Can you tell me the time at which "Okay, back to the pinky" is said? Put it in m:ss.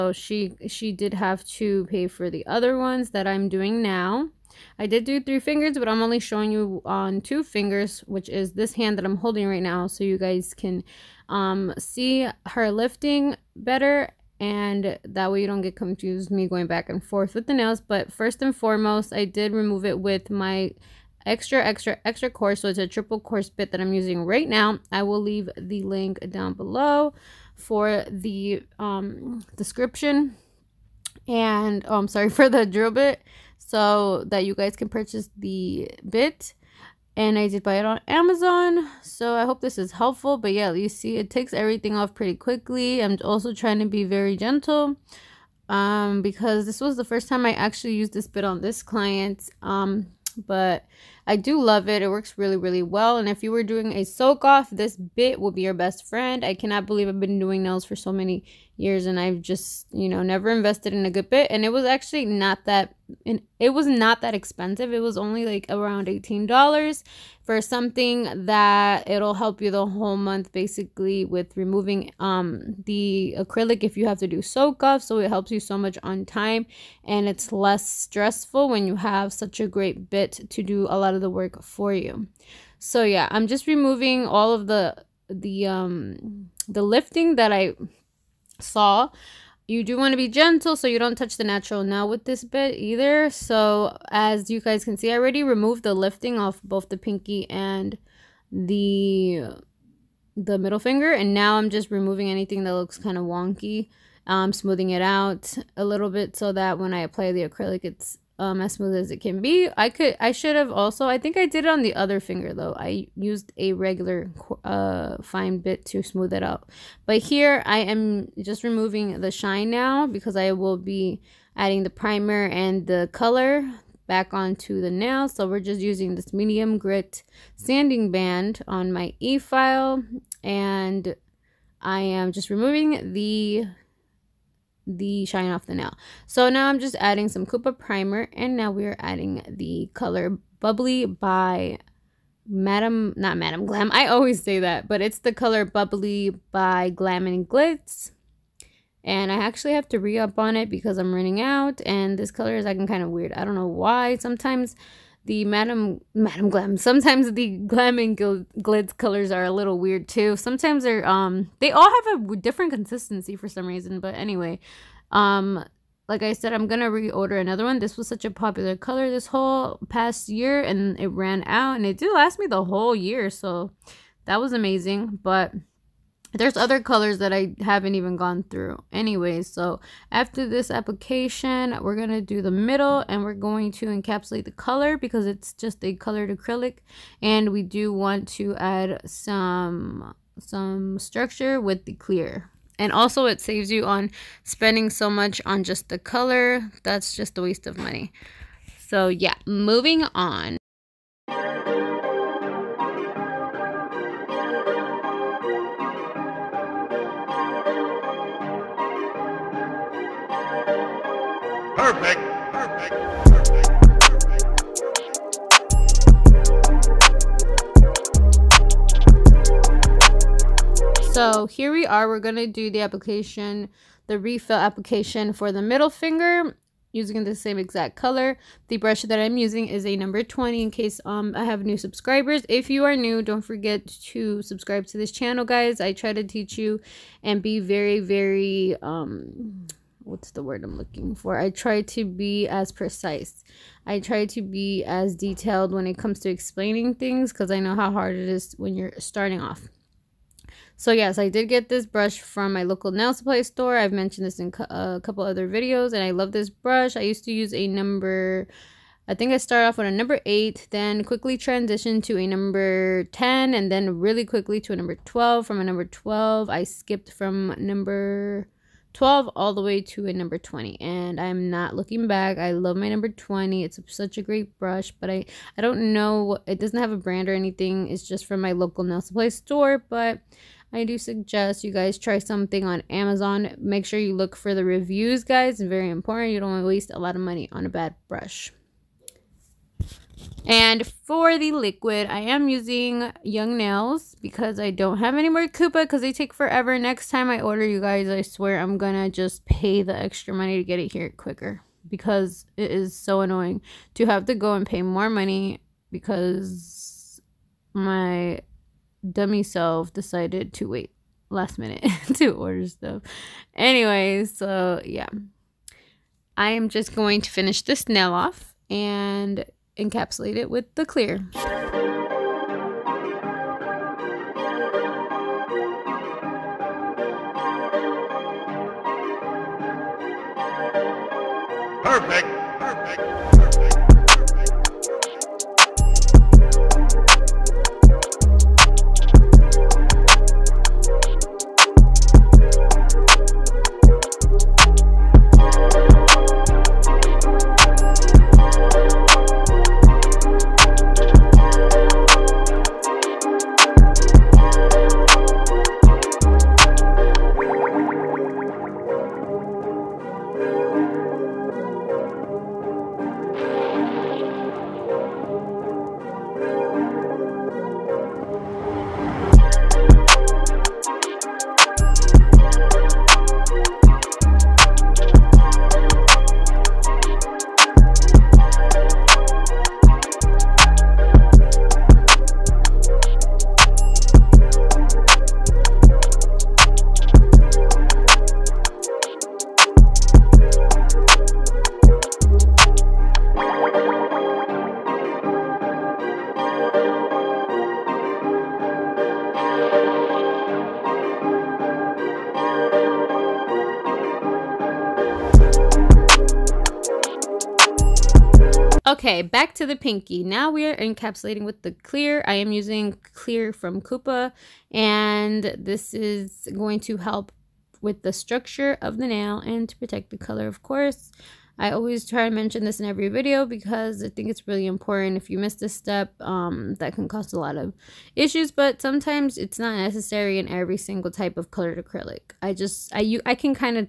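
6:48.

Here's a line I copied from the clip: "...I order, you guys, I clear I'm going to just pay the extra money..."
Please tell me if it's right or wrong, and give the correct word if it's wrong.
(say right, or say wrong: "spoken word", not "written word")
wrong: "swear", not "clear".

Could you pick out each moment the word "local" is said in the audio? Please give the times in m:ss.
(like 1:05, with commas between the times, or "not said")
4:12, 4:38.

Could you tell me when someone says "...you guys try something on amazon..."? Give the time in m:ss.
4:41.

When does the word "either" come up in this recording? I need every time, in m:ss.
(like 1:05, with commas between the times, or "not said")
1:32.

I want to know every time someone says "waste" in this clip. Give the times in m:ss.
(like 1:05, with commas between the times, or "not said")
3:17, 4:46.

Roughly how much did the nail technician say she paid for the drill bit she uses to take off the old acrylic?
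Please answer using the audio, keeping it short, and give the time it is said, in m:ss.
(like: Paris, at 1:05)
$18, at 1:06.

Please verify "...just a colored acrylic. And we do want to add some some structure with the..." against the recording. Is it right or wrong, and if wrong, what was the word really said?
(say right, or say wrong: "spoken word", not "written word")
right.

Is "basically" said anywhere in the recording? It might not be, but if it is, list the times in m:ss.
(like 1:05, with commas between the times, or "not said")
1:10.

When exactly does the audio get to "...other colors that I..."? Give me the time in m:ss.
2:56.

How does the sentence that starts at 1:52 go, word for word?
I used a regular uh, fine bit to smooth it out.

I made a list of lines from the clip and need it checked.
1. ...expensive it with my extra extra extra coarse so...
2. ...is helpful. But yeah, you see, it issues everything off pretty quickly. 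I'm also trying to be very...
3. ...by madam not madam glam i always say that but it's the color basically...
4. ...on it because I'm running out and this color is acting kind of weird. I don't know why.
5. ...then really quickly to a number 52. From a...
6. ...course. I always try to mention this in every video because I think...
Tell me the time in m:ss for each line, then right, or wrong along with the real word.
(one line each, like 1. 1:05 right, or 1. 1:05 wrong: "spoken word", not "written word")
1. 0:19 wrong: "remove", not "expensive"
2. 0:39 wrong: "takes", not "issues"
3. 2:21 wrong: "bubbly", not "basically"
4. 2:30 right
5. 4:23 wrong: "12", not "52"
6. 7:00 right.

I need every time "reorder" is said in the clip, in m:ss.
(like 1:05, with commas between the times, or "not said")
2:46.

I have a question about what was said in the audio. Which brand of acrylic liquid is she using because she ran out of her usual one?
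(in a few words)
Young Nails.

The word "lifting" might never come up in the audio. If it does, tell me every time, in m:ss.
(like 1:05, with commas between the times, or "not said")
0:12, 1:26, 1:35.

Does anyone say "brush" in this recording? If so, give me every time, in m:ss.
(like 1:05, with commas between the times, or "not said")
3:48, 4:11, 4:16, 4:34, 4:48.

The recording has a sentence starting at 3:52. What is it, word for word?
If you are new, don't forget to subscribe to this channel, guys.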